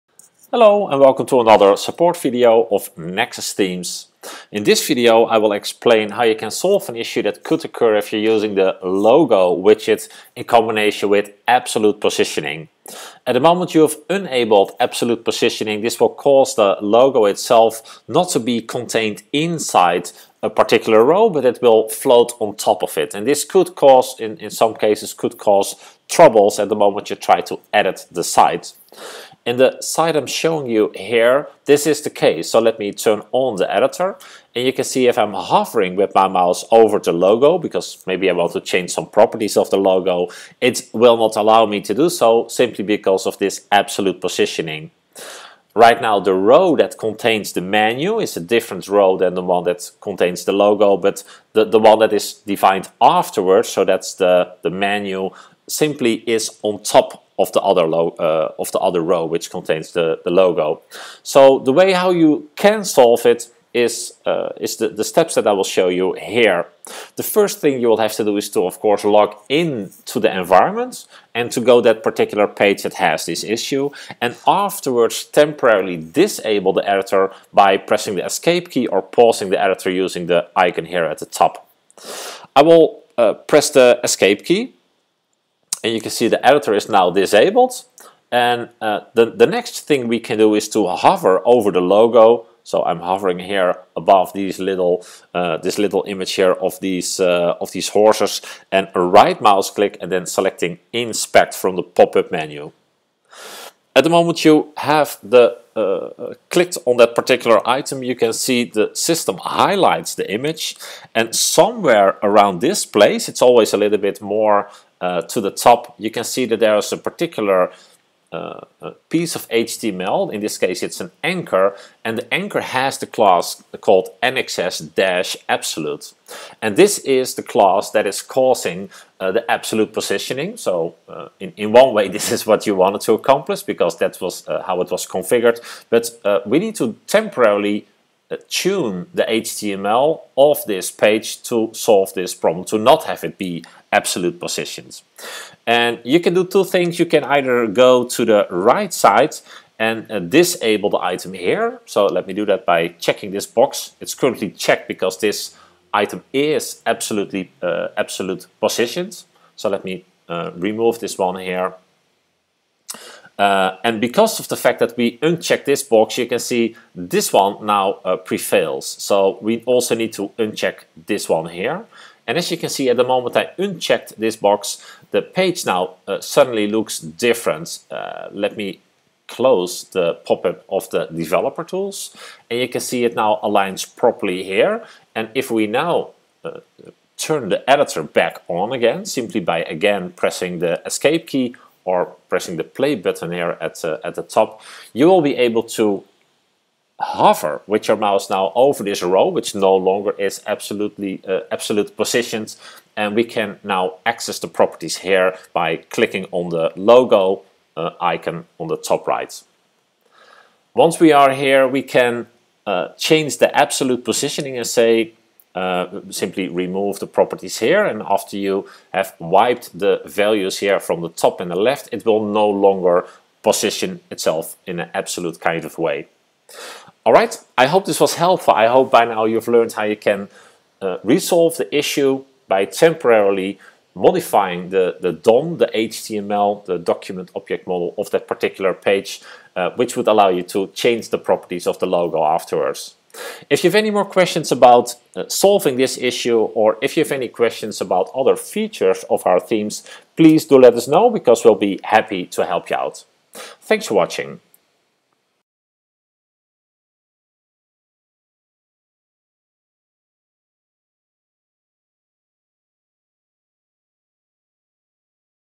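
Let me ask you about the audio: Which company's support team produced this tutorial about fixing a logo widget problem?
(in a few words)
Nexus Themes.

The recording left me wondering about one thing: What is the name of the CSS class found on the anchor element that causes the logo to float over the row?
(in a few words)
nxs-absolute.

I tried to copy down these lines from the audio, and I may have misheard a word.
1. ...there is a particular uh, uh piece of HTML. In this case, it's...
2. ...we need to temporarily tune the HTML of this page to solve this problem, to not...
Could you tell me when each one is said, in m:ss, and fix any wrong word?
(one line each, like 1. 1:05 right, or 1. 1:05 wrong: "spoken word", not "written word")
1. 1:56 right
2. 2:16 right.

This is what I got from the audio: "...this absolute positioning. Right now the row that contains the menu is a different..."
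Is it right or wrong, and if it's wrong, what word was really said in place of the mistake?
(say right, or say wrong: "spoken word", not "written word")
right.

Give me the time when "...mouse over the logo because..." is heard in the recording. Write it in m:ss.
0:36.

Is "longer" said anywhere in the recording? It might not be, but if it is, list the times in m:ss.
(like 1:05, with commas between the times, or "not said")
3:19, 3:42.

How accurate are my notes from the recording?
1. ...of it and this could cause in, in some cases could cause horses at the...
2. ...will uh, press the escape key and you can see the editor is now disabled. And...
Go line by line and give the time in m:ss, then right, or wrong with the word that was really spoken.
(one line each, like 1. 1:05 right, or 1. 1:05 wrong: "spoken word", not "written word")
1. 0:22 wrong: "troubles", not "horses"
2. 1:22 right.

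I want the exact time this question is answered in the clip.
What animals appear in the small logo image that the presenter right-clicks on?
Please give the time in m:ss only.
1:37.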